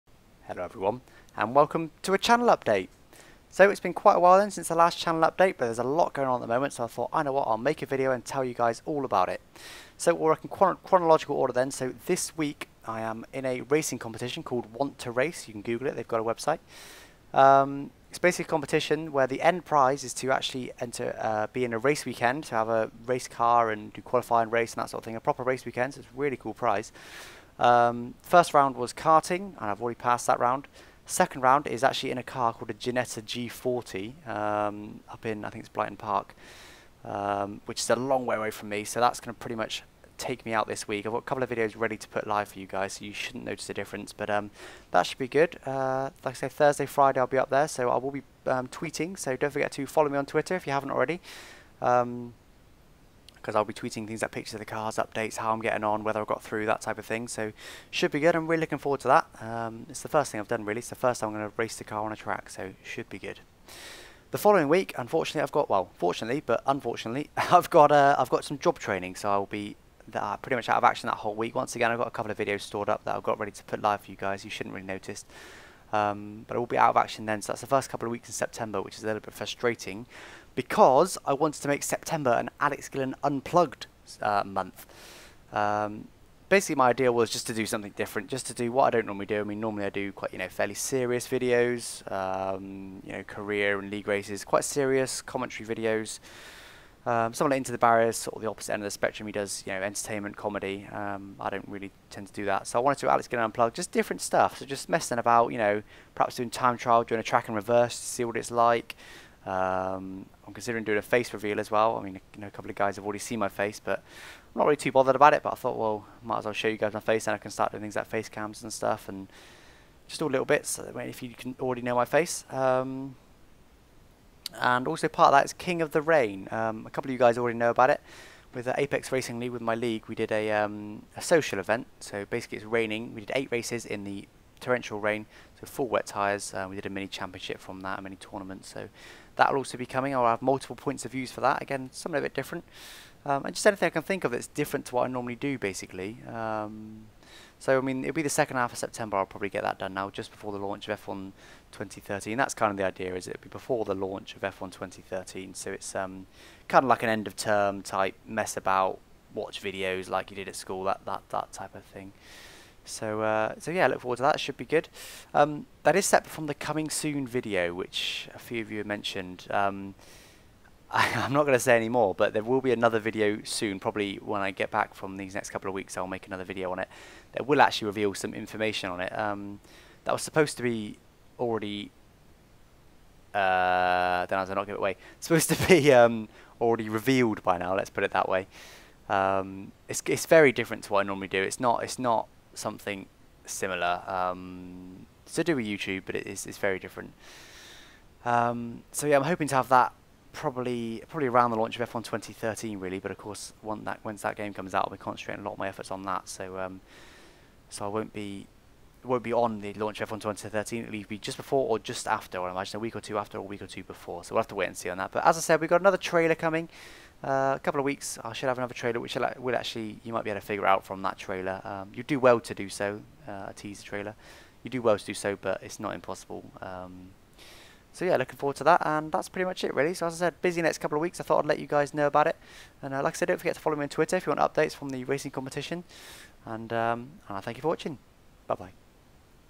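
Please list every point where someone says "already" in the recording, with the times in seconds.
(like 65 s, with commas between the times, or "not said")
29 s, 50 s, 113 s, 121 s, 127 s, 181 s, 186 s.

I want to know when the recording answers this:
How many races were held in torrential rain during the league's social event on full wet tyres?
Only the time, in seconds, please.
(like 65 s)
133 s.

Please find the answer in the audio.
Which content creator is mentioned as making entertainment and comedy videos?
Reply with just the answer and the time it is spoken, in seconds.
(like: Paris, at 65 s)
Into the Barriers, at 97 s.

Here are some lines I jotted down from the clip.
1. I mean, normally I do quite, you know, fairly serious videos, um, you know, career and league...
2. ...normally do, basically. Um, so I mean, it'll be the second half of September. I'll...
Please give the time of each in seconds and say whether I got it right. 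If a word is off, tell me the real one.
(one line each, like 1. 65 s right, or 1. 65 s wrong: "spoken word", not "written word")
1. 89 s right
2. 145 s right.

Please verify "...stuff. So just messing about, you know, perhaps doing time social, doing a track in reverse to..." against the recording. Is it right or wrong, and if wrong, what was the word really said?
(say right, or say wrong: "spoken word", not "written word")
wrong: "trial", not "social".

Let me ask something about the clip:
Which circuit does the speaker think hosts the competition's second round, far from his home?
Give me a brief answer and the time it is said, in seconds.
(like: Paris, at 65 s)
Blyton Park, at 35 s.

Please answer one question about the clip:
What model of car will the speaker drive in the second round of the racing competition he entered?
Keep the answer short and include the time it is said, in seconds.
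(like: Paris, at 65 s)
Ginetta G40, at 32 s.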